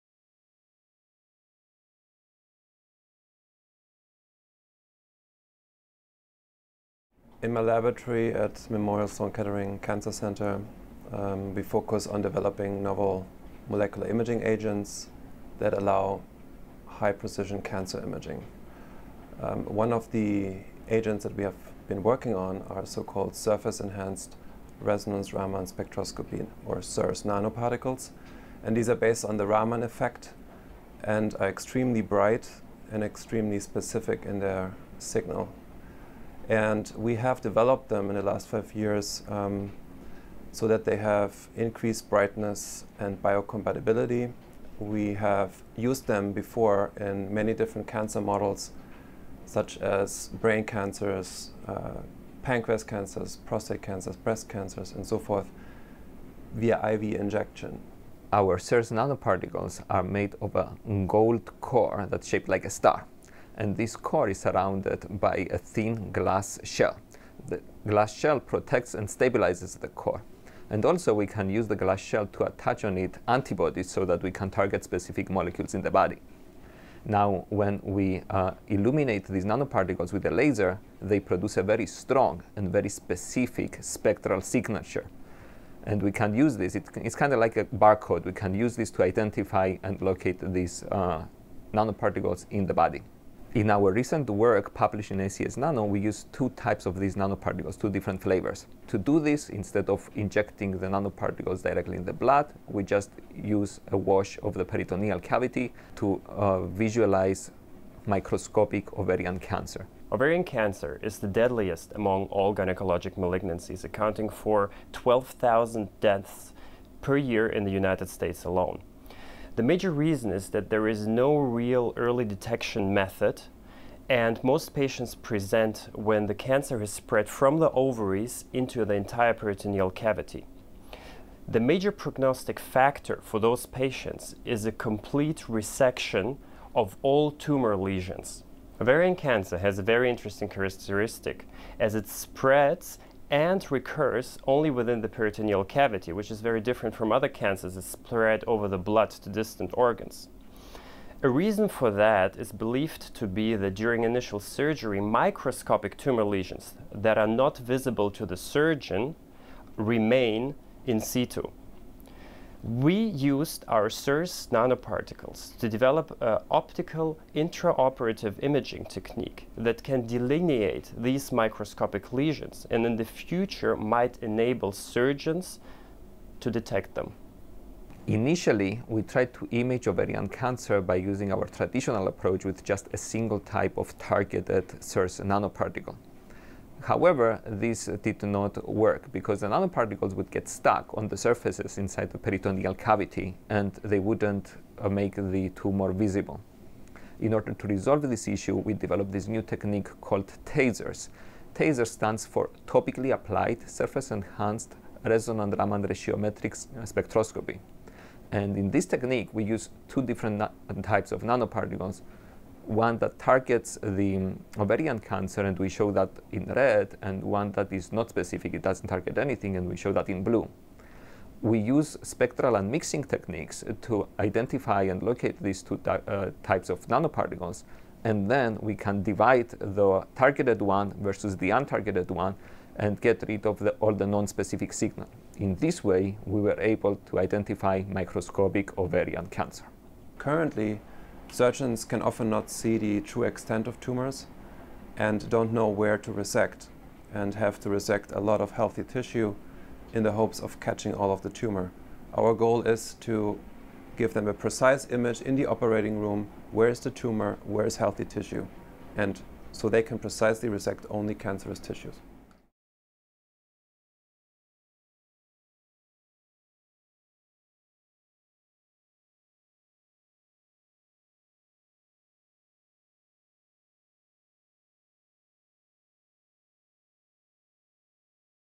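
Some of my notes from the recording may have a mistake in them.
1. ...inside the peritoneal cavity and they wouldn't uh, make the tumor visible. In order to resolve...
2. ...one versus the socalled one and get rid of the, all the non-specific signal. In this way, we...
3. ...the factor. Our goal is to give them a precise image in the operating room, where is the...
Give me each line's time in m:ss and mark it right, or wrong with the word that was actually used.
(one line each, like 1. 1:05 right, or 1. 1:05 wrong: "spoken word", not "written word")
1. 3:11 right
2. 3:50 wrong: "untargeted", not "socalled"
3. 4:11 wrong: "tumor", not "factor".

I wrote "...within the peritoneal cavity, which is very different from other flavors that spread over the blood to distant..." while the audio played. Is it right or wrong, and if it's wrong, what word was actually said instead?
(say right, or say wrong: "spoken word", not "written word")
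wrong: "cancers", not "flavors".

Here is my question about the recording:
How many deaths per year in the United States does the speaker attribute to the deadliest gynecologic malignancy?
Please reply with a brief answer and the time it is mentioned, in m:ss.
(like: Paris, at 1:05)
12,000, at 1:54.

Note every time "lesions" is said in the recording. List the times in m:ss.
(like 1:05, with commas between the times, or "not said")
2:17, 2:36, 2:52.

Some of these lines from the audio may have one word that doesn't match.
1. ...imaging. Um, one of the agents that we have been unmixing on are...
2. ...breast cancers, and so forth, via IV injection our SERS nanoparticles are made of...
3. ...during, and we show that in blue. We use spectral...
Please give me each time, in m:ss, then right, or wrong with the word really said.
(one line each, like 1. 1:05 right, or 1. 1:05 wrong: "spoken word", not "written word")
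1. 0:18 wrong: "working", not "unmixing"
2. 0:54 right
3. 3:39 wrong: "anything", not "during".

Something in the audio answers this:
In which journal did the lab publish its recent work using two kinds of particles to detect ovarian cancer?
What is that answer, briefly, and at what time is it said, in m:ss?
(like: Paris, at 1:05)
ACS Nano, at 1:35.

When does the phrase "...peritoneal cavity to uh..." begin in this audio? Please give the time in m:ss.
1:44.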